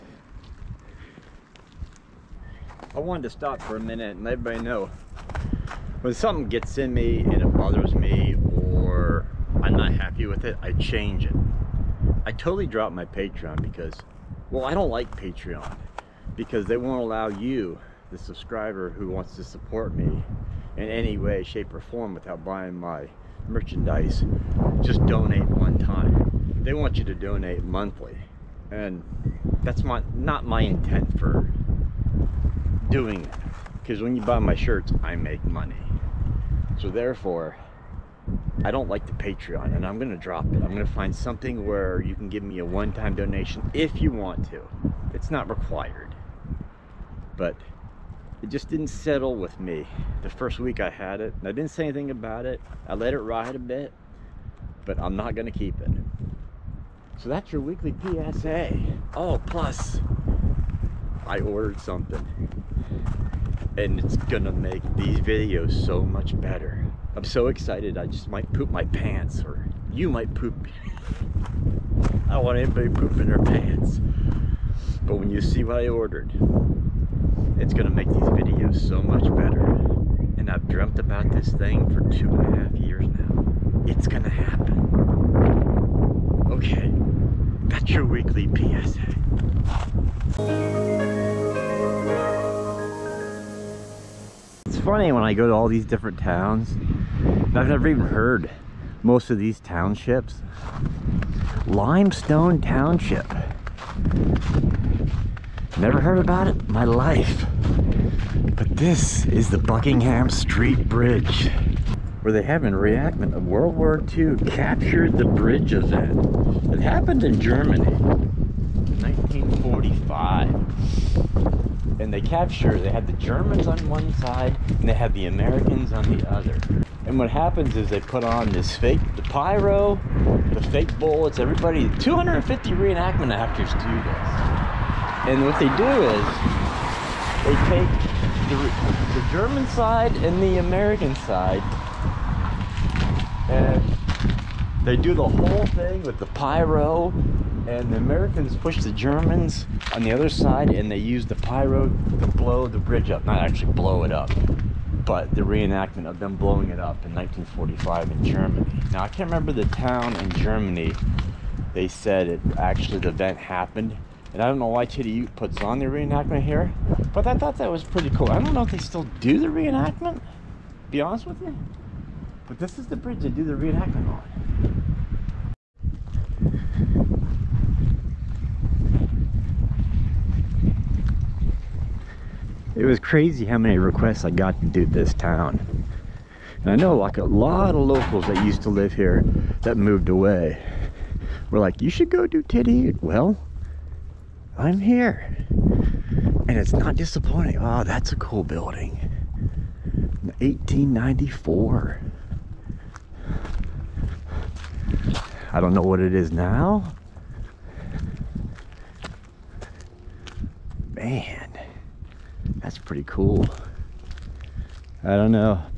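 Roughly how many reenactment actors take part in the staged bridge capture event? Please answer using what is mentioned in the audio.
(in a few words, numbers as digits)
250.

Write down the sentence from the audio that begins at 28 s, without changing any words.
And that's my, not my intent for doing it because when you buy my shirts, I make money.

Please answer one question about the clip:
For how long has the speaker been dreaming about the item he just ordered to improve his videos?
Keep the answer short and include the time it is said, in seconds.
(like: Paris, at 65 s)
2.5 years, at 82 s.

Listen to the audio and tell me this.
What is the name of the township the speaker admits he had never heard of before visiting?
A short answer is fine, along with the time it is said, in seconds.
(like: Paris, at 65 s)
Limestone Township, at 101 s.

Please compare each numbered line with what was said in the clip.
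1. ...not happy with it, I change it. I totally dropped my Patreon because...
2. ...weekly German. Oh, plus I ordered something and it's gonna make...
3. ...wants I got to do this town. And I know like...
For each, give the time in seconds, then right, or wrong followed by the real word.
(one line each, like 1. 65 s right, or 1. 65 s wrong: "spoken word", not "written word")
1. 9 s right
2. 57 s wrong: "PSA", not "German"
3. 183 s wrong: "requests", not "wants".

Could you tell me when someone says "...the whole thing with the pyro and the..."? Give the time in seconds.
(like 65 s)
145 s.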